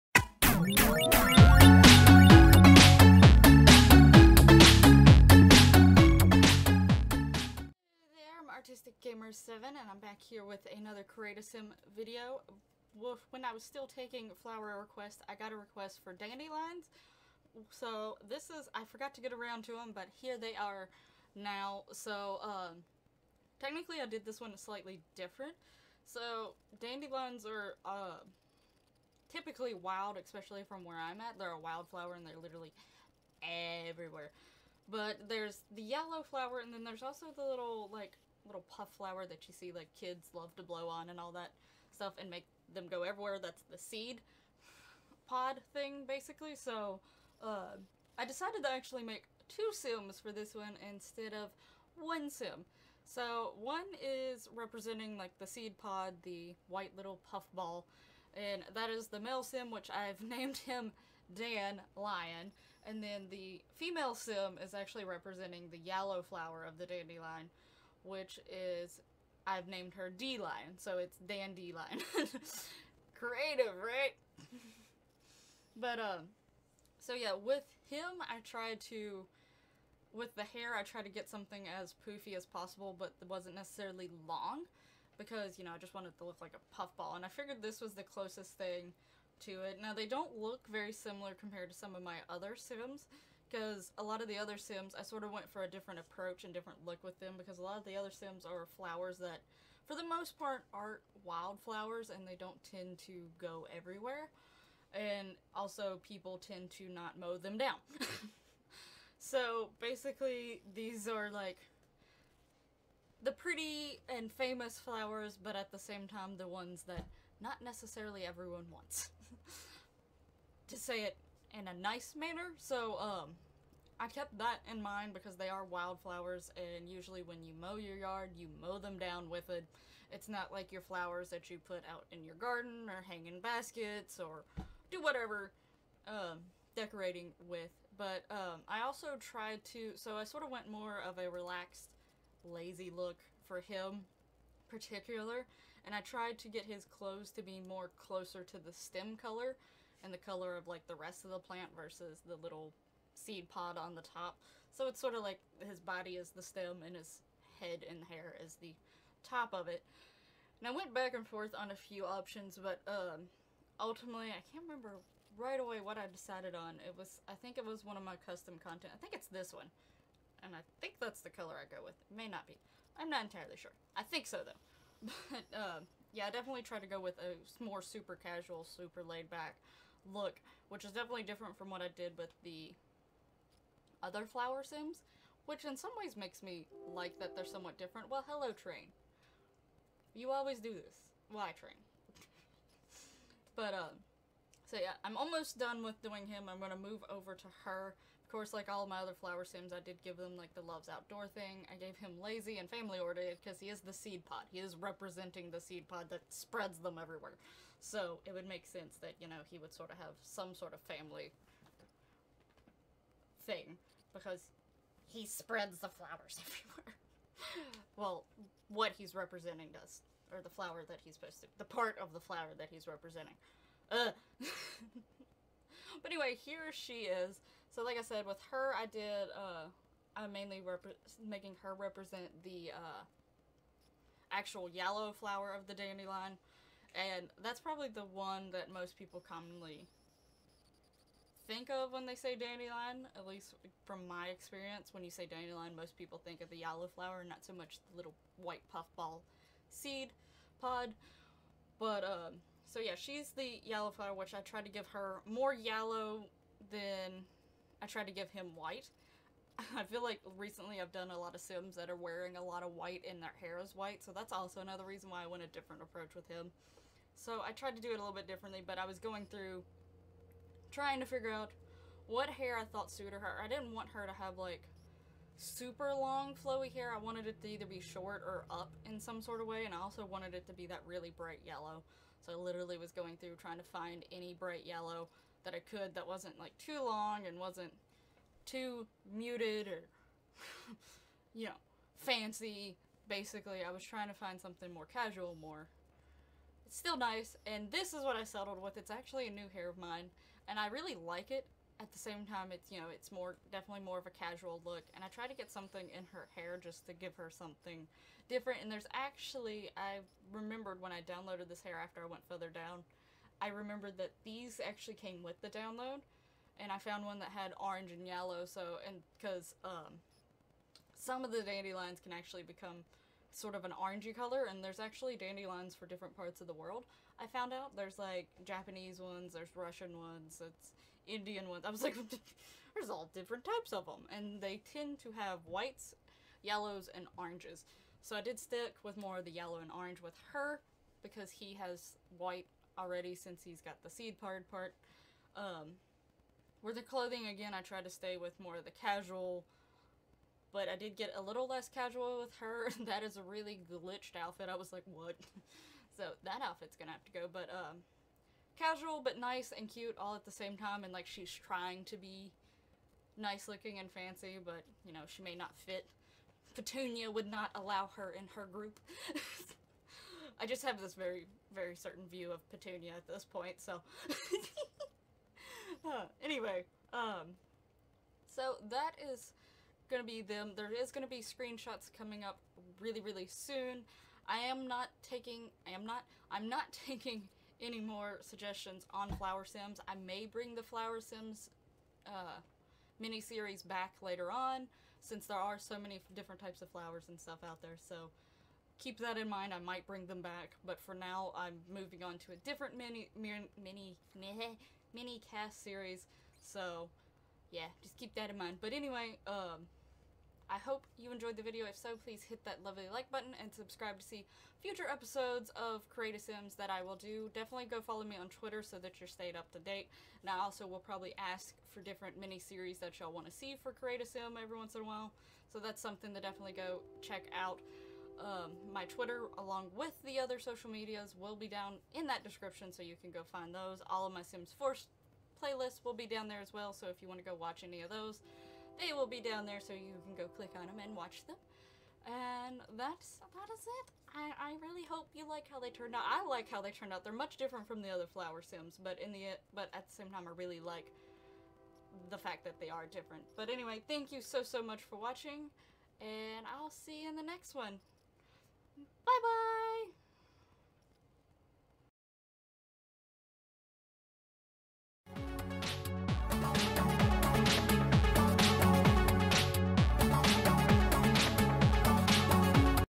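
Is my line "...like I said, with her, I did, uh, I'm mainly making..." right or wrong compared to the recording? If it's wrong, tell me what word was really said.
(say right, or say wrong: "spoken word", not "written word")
right.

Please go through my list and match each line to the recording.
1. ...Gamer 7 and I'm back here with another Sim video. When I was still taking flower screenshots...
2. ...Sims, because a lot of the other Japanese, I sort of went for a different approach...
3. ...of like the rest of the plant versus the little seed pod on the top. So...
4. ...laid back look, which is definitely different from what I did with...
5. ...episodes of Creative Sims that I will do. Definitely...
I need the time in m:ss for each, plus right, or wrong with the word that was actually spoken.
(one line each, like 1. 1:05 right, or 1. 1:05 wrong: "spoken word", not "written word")
1. 0:09 wrong: "requests", not "screenshots"
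2. 1:32 wrong: "Sims", not "Japanese"
3. 2:30 right
4. 2:59 right
5. 6:54 right.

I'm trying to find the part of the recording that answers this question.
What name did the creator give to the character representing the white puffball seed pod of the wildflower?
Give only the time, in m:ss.
1:01.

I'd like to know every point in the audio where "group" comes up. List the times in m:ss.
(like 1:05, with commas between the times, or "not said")
6:08.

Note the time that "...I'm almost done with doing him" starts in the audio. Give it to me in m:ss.
3:15.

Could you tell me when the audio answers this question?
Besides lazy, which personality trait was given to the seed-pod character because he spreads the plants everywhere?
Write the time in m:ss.
3:22.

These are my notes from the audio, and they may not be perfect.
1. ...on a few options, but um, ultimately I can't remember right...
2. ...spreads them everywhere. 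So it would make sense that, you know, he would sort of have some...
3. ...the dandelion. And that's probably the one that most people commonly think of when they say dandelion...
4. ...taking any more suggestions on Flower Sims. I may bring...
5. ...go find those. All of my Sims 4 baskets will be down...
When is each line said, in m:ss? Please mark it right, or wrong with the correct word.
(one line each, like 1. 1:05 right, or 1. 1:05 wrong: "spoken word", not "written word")
1. 2:41 right
2. 3:26 right
3. 3:55 right
4. 6:26 right
5. 7:13 wrong: "playlists", not "baskets".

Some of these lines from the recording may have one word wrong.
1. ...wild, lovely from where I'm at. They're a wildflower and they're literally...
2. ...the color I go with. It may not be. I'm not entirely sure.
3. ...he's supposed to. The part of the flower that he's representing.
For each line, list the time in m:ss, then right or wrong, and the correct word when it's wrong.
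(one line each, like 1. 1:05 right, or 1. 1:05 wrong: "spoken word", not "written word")
1. 0:29 wrong: "especially", not "lovely"
2. 2:51 right
3. 3:41 right.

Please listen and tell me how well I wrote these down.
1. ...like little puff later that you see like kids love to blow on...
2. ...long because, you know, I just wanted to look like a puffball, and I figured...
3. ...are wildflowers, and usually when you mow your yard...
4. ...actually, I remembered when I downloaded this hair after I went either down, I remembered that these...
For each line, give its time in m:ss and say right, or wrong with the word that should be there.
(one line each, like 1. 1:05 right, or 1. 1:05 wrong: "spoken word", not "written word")
1. 0:37 wrong: "flower", not "later"
2. 1:24 right
3. 2:05 right
4. 5:08 wrong: "further", not "either".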